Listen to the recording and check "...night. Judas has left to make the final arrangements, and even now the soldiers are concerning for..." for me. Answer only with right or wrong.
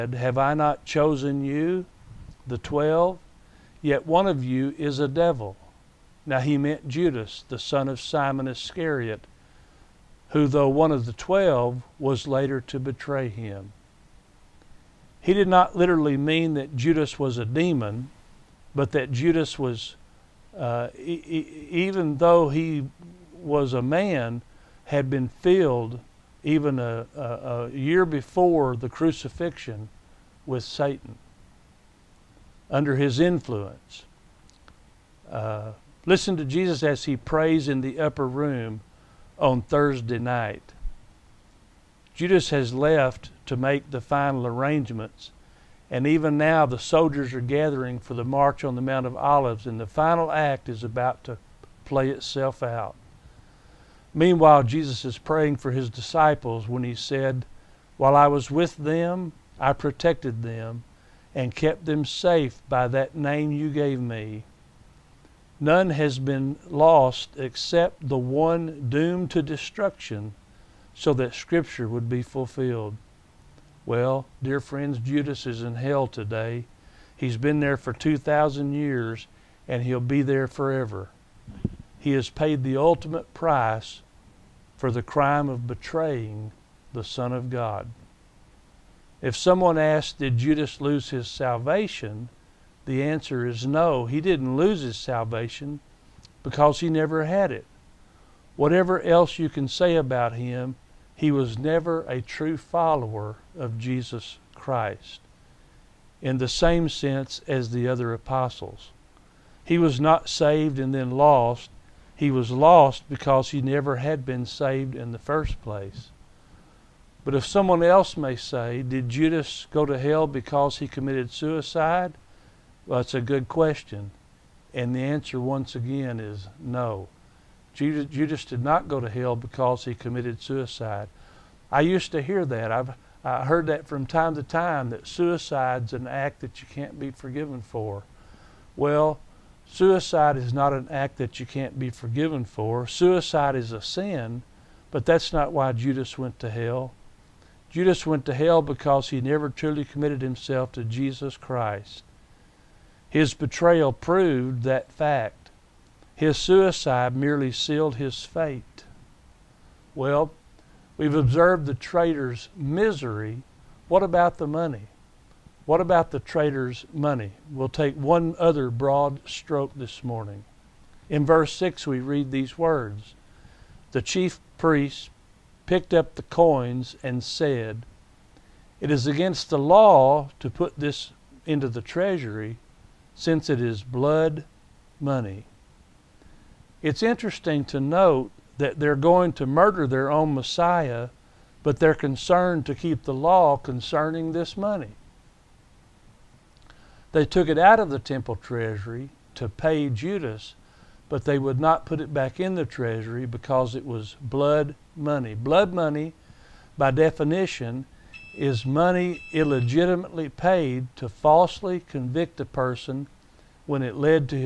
wrong.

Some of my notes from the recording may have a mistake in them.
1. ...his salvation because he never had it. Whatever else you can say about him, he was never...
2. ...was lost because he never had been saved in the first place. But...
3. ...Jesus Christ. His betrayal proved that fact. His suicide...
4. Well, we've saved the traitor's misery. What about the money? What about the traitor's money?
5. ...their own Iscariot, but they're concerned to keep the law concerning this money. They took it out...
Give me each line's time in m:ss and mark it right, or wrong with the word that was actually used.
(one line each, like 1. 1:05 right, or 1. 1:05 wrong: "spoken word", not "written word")
1. 1:34 right
2. 1:52 right
3. 2:30 right
4. 2:39 wrong: "observed", not "saved"
5. 3:09 wrong: "Messiah", not "Iscariot".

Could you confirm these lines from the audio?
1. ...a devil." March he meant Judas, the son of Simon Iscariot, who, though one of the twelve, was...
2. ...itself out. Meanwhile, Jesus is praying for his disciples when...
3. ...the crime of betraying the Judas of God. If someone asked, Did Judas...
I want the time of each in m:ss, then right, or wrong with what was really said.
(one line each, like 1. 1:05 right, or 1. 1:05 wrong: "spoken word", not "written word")
1. 0:04 wrong: "Now", not "March"
2. 0:52 right
3. 1:24 wrong: "Son", not "Judas".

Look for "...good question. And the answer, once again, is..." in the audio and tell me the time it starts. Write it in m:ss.
2:03.